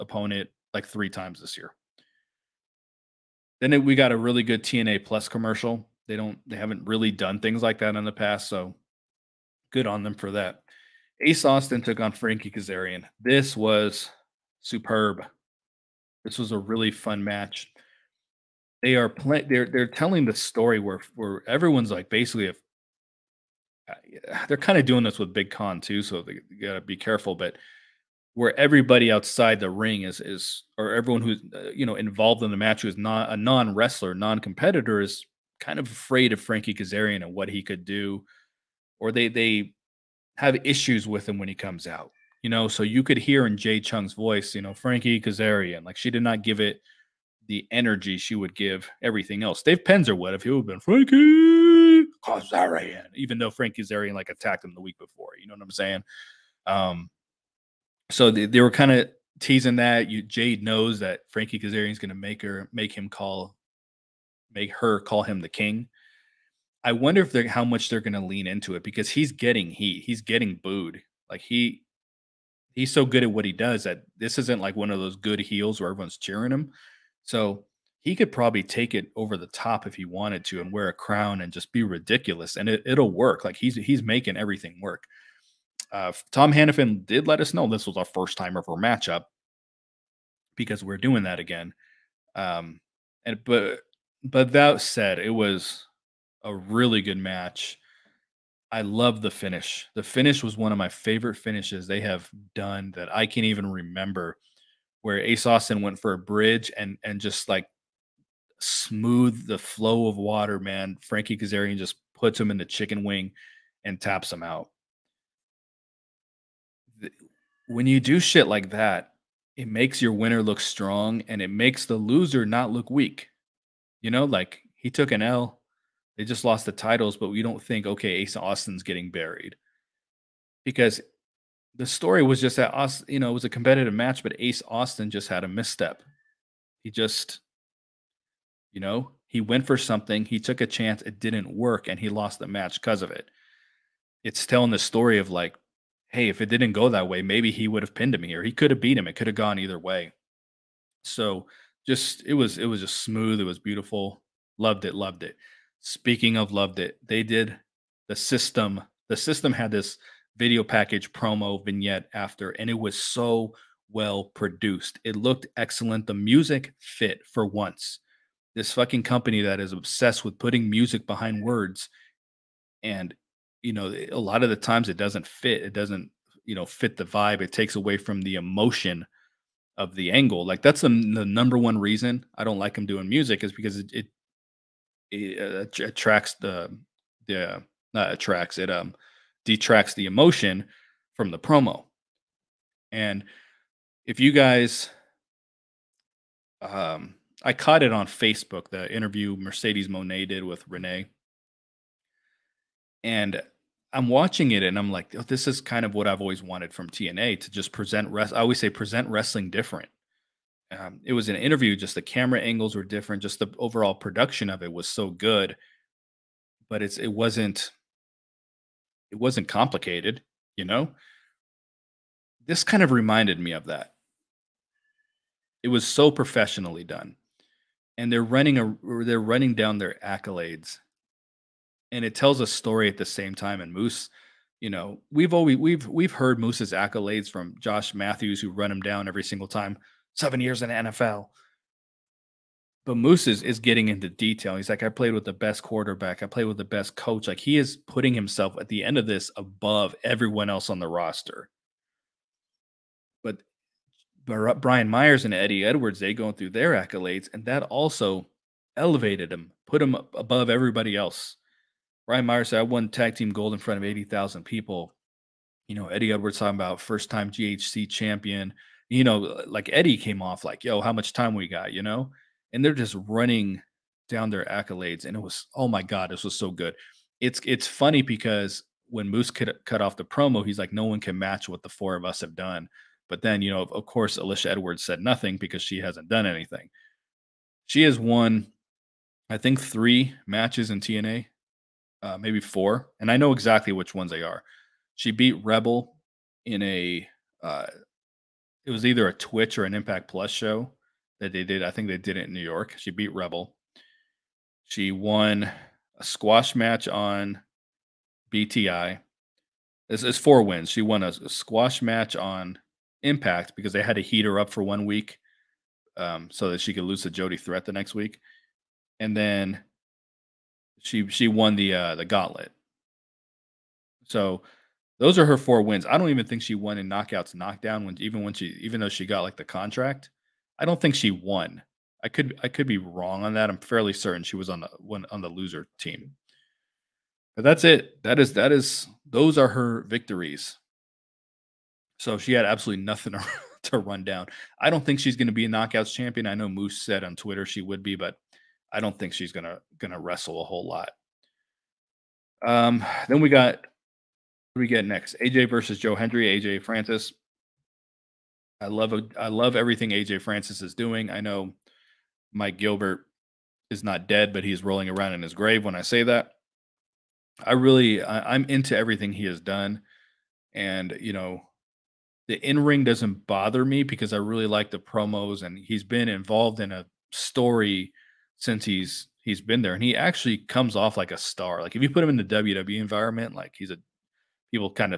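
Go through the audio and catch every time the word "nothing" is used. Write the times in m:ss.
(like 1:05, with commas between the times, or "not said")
4:44, 5:42.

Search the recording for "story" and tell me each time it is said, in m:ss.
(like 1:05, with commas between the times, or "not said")
0:20, 2:11, 2:24, 3:52, 6:17.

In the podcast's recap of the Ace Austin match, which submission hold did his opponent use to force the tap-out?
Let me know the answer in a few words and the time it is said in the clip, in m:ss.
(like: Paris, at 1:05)
Chicken wing, at 1:52.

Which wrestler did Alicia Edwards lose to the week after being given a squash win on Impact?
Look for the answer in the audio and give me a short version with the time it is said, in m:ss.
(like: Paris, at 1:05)
Jody Threat, at 5:17.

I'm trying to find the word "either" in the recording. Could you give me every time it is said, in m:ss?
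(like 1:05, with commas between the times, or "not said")
2:29, 4:58.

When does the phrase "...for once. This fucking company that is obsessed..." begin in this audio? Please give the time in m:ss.
2:47.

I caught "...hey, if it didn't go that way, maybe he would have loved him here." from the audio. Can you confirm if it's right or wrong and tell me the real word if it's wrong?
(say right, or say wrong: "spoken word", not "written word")
wrong: "pinned", not "loved".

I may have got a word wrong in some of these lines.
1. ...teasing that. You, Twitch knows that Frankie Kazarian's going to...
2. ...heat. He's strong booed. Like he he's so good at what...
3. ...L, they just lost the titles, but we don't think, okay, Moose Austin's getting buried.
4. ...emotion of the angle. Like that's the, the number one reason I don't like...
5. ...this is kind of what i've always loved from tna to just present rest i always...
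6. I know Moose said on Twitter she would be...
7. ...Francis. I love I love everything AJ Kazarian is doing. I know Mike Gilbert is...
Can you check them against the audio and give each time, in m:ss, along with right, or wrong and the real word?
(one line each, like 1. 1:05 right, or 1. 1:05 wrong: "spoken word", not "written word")
1. 0:59 wrong: "Jade", not "Twitch"
2. 1:09 wrong: "getting", not "strong"
3. 2:05 wrong: "Ace", not "Moose"
4. 2:58 right
5. 3:25 wrong: "wanted", not "loved"
6. 5:46 right
7. 5:56 wrong: "Francis", not "Kazarian".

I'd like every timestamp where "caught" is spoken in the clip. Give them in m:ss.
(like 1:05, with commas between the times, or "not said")
3:17.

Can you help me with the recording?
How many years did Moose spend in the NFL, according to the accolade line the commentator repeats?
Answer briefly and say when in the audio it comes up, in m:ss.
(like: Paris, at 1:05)
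7, at 4:00.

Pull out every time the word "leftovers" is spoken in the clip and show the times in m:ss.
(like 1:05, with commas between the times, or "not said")
not said.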